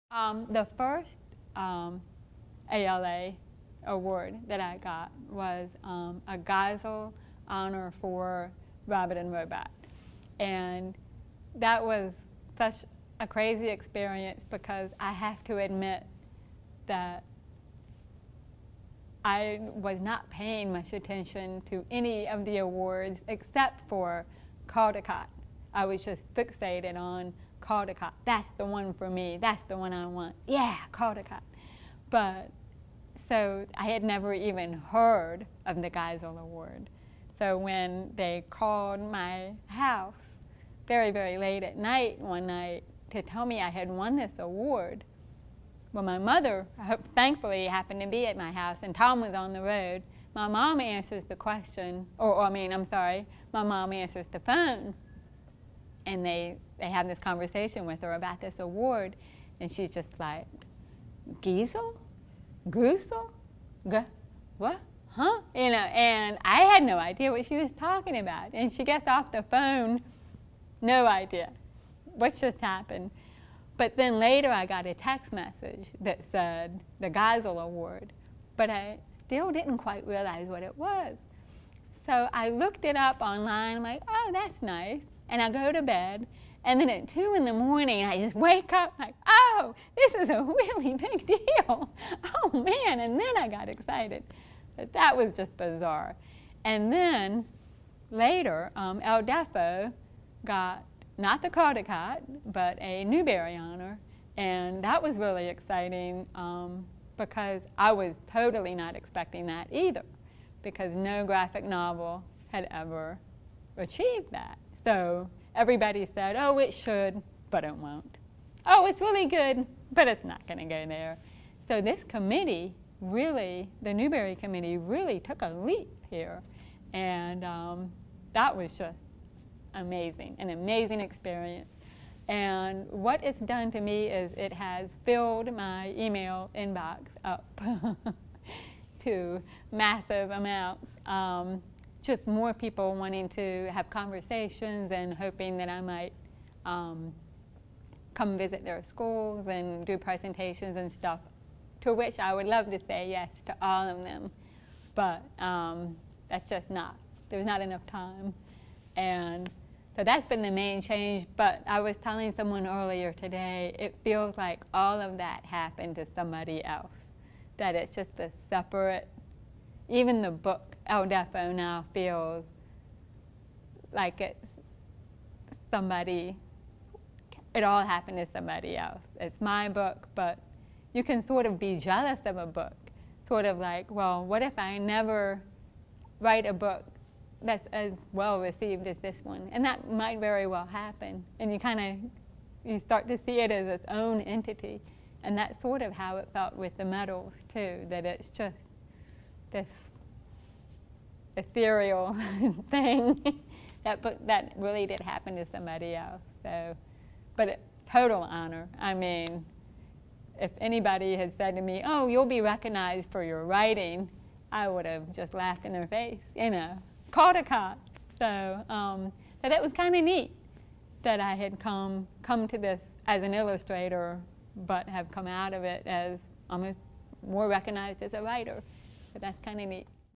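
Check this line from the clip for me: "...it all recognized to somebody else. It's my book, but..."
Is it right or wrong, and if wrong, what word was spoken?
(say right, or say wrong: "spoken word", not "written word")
wrong: "happened", not "recognized".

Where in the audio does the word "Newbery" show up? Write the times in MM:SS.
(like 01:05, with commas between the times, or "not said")
01:43, 02:03.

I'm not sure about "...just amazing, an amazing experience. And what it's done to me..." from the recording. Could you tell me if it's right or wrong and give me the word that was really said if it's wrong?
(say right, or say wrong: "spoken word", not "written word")
right.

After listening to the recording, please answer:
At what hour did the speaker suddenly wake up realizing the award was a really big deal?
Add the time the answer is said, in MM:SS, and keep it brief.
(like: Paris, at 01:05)
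2 in the morning, at 01:27.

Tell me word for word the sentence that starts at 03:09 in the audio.
And that might very well happen.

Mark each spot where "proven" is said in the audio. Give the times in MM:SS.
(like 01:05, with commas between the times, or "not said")
not said.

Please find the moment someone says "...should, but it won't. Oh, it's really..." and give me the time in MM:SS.
01:56.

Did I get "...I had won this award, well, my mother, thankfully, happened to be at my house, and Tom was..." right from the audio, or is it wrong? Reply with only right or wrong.
right.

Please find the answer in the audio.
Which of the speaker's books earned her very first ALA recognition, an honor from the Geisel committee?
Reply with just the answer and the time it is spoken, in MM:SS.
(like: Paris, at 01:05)
Rabbit and Robot, at 00:08.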